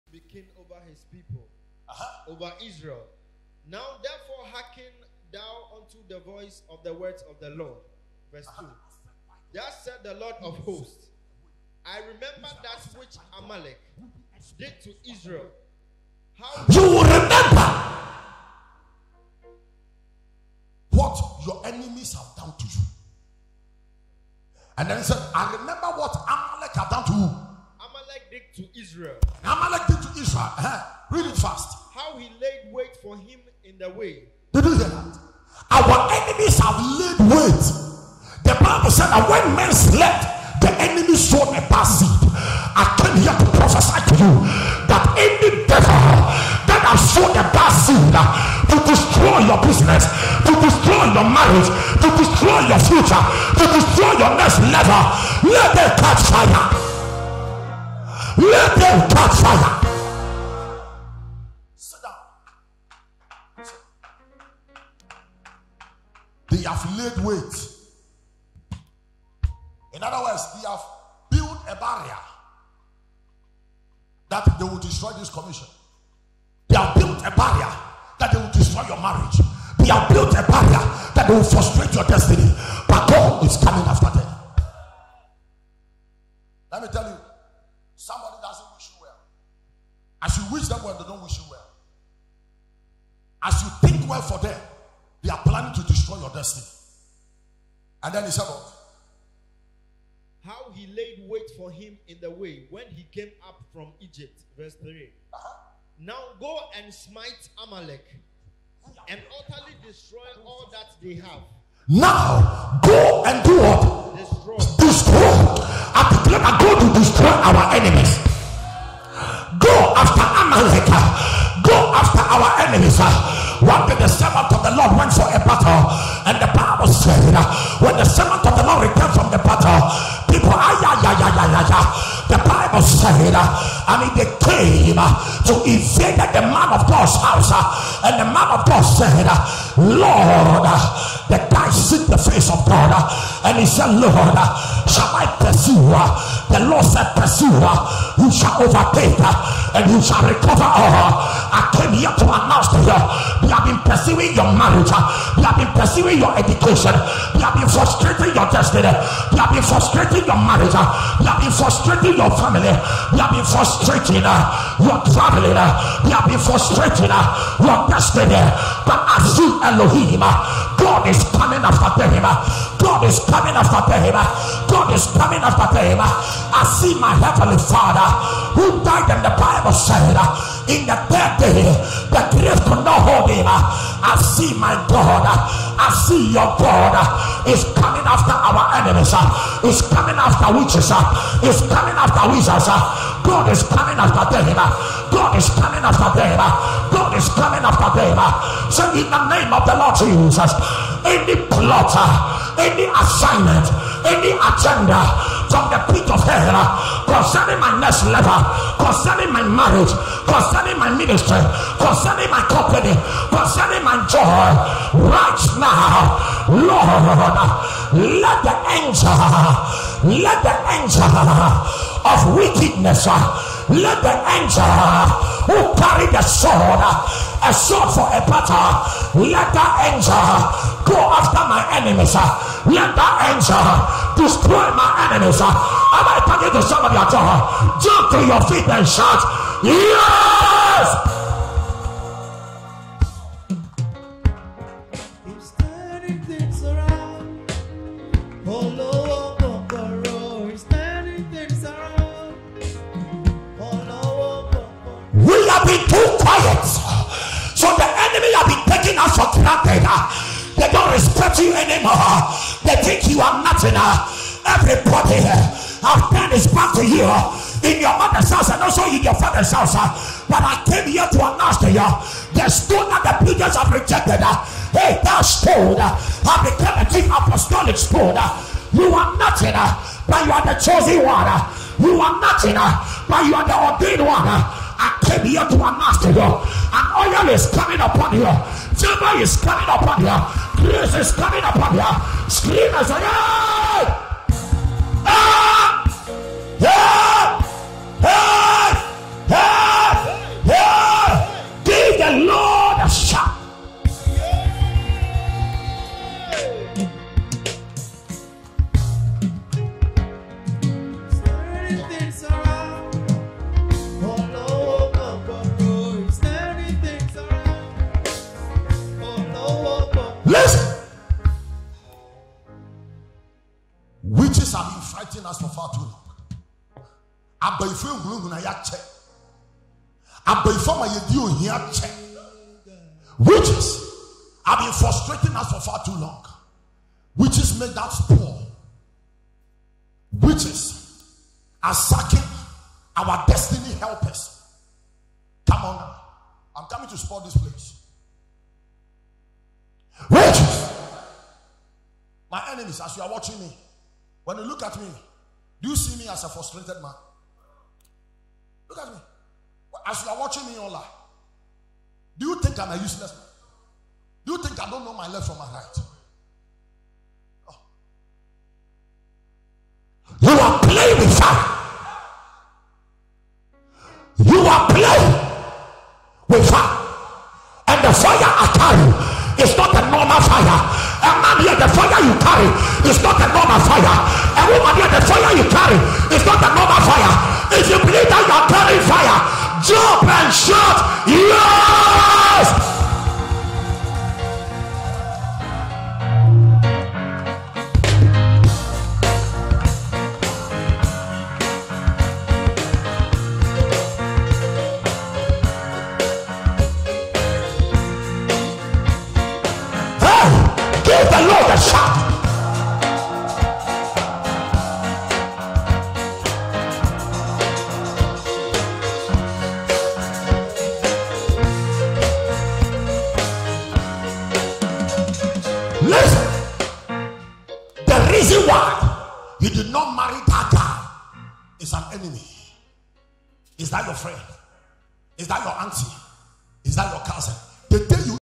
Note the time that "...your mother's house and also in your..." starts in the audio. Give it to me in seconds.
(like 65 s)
267 s.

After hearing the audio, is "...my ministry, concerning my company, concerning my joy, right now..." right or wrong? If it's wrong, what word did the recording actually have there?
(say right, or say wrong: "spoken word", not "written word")
right.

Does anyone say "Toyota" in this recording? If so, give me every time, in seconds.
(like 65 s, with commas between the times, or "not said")
not said.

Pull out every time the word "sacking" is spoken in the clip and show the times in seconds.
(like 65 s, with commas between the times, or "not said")
341 s.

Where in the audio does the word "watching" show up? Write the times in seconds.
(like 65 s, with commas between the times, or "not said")
353 s, 360 s.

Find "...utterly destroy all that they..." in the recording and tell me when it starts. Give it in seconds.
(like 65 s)
109 s.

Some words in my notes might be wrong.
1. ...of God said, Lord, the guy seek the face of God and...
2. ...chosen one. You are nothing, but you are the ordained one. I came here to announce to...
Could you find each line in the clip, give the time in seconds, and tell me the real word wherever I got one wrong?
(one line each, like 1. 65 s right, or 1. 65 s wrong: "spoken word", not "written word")
1. 138 s right
2. 280 s right.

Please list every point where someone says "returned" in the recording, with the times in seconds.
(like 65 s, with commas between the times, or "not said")
128 s.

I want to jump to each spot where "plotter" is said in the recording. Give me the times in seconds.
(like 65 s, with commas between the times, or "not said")
201 s.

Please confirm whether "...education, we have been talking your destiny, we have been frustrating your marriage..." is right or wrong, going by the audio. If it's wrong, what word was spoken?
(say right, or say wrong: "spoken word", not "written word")
wrong: "frustrating", not "talking".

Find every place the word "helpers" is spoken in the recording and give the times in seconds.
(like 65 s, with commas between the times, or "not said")
343 s.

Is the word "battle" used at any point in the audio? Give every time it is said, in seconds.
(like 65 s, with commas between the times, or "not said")
125 s, 129 s, 228 s.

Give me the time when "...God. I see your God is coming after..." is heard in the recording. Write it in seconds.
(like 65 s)
184 s.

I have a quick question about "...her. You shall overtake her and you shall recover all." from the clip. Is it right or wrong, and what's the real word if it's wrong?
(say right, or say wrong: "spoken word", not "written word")
right.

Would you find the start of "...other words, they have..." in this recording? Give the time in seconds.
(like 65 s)
70 s.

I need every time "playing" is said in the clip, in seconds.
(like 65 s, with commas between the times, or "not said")
370 s, 374 s.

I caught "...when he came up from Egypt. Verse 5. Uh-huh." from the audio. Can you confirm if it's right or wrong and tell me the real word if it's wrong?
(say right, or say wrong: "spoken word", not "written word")
wrong: "3", not "5".